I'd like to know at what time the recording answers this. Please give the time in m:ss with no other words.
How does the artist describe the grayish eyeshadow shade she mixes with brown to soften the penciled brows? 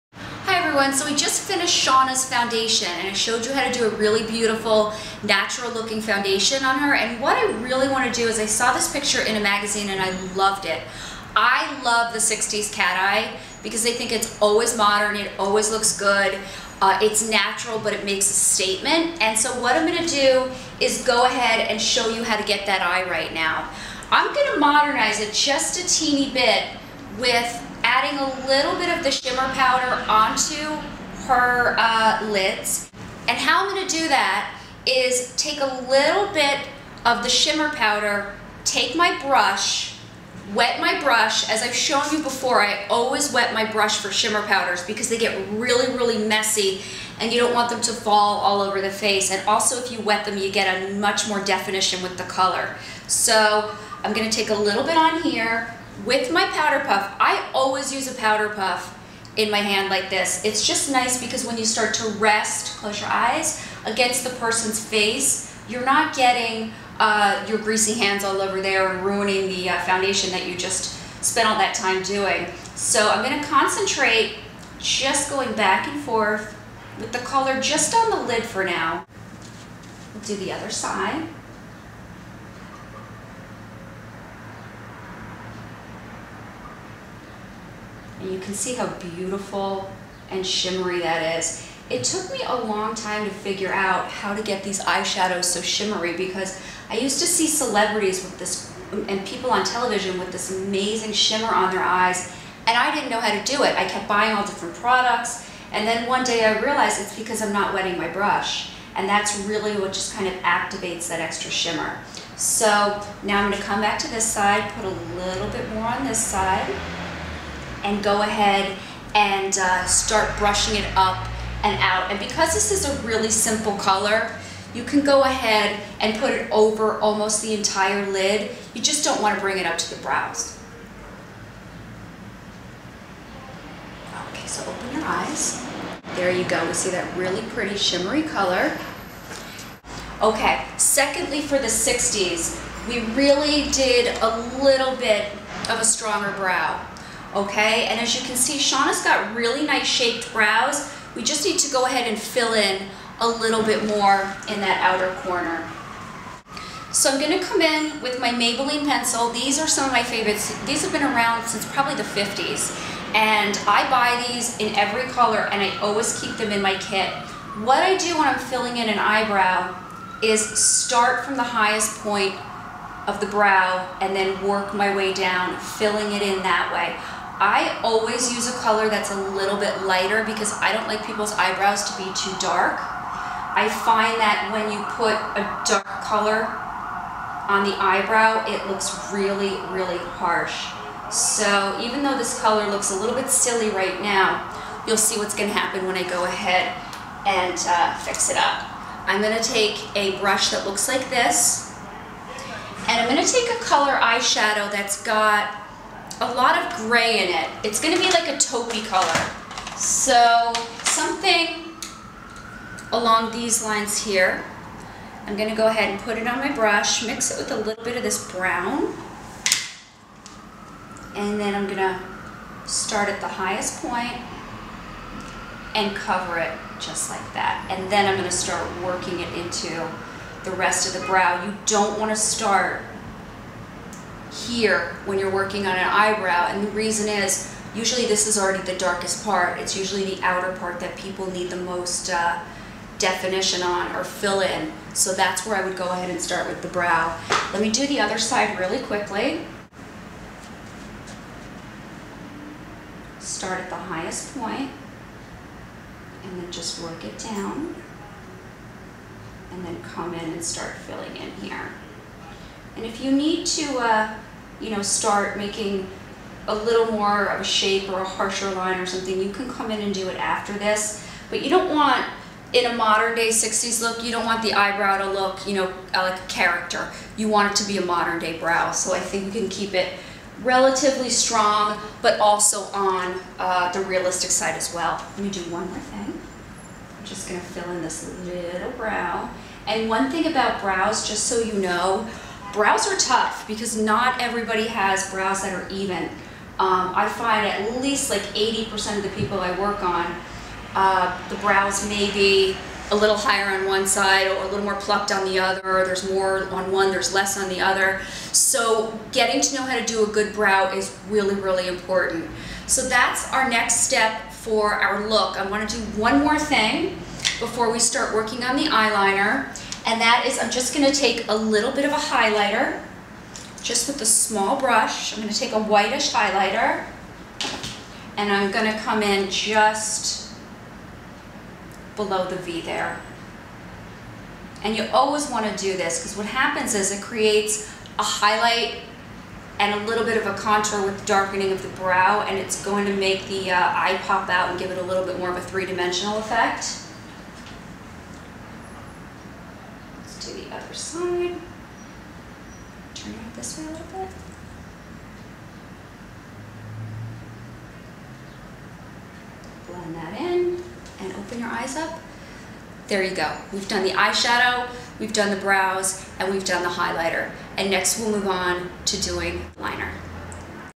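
3:28.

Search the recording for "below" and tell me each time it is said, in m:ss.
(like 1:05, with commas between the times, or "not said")
5:31.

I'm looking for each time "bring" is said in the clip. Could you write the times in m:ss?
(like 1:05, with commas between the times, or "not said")
2:09.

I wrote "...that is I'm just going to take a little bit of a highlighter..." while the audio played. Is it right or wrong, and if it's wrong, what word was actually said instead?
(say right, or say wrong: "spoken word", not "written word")
right.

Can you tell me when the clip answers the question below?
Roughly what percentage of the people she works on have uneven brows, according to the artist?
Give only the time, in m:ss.
4:58.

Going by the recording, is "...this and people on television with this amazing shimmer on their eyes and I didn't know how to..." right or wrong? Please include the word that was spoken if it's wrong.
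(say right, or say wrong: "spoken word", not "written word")
right.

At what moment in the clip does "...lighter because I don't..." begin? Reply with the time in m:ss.
2:59.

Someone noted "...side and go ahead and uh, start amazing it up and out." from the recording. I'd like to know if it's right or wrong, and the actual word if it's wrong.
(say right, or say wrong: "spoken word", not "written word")
wrong: "brushing", not "amazing".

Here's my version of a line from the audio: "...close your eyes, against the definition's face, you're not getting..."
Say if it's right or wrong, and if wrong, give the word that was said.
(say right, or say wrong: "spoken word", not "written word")
wrong: "person", not "definition".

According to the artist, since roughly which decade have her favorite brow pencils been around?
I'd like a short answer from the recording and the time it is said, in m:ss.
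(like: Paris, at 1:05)
50s, at 2:42.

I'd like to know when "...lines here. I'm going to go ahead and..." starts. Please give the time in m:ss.
3:33.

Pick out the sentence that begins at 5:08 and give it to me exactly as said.
So getting to know how to do a good brow is really, really important.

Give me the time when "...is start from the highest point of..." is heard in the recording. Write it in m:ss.
2:50.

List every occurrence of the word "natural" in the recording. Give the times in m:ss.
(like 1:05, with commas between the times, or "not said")
0:05, 0:17.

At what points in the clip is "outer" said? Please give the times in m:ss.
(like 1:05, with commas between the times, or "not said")
2:34, 4:00.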